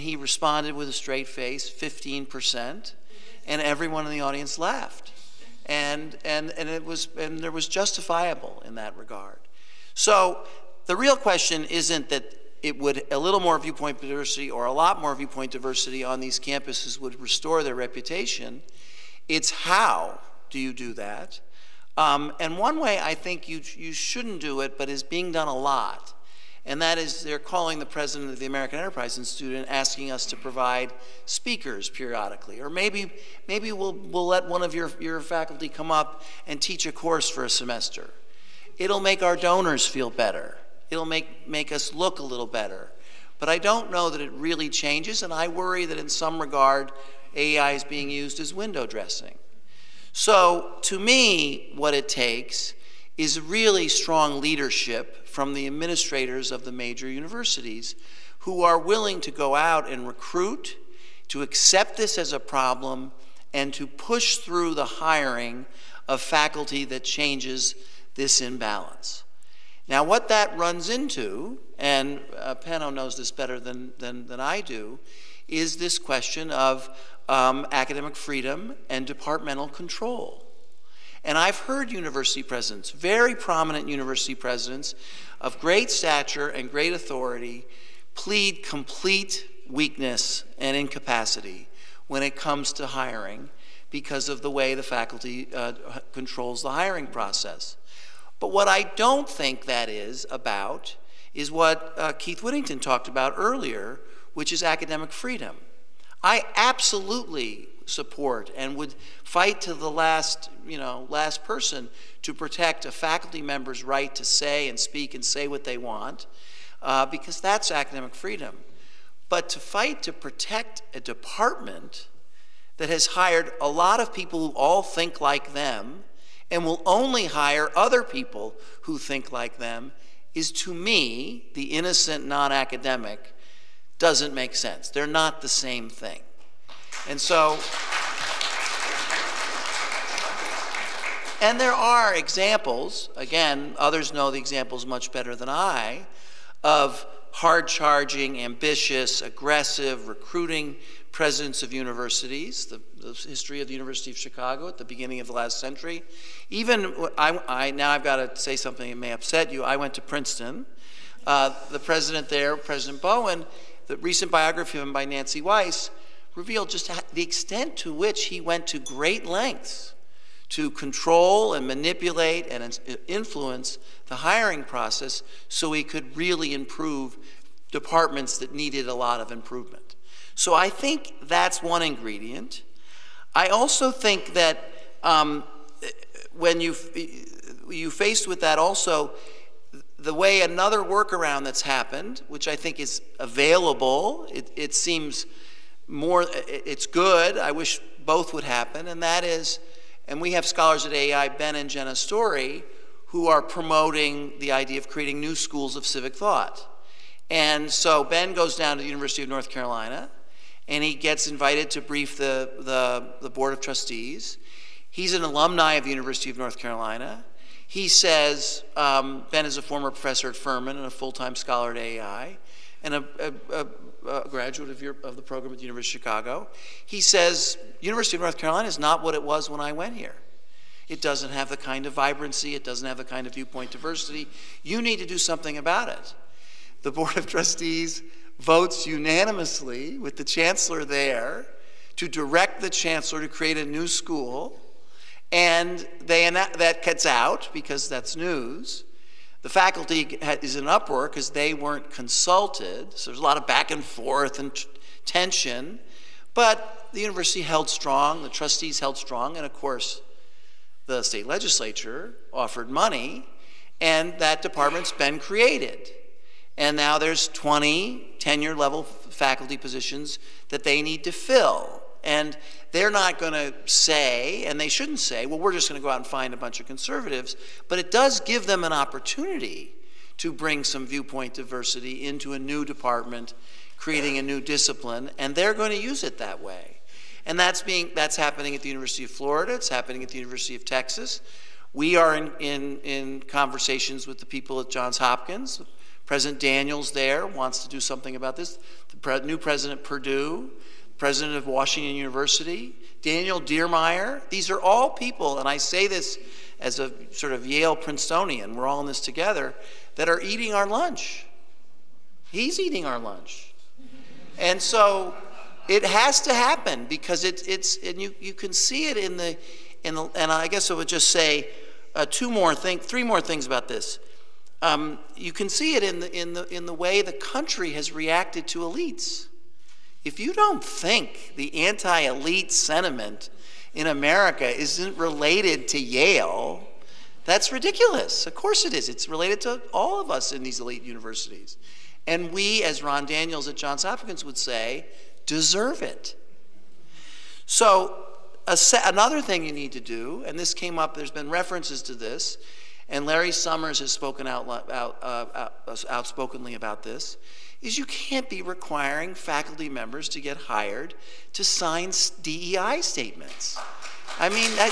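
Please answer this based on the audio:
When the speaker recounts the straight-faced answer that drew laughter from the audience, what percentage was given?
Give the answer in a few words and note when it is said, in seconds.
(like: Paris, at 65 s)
15%, at 1 s.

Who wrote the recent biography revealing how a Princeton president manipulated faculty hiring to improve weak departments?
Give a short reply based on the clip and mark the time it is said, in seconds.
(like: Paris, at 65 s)
Nancy Weiss, at 165 s.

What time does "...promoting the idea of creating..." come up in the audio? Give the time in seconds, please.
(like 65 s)
203 s.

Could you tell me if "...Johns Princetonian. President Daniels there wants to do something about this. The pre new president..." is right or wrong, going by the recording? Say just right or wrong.
wrong.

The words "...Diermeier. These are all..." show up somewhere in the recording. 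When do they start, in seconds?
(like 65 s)
303 s.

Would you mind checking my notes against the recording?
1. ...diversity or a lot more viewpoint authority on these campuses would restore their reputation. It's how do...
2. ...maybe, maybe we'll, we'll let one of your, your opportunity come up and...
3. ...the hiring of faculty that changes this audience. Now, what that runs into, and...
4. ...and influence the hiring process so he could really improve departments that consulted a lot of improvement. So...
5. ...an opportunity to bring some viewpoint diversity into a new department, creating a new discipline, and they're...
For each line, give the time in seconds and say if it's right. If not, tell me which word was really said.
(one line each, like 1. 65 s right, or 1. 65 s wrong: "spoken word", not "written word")
1. 14 s wrong: "diversity", not "authority"
2. 32 s wrong: "faculty", not "opportunity"
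3. 64 s wrong: "imbalance", not "audience"
4. 172 s wrong: "needed", not "consulted"
5. 278 s right.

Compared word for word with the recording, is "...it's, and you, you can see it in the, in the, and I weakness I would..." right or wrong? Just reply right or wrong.
wrong.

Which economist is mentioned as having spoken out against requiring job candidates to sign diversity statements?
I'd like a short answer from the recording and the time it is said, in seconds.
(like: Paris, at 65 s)
Larry Summers, at 353 s.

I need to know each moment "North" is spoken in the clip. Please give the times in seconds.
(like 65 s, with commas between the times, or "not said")
209 s, 216 s, 228 s.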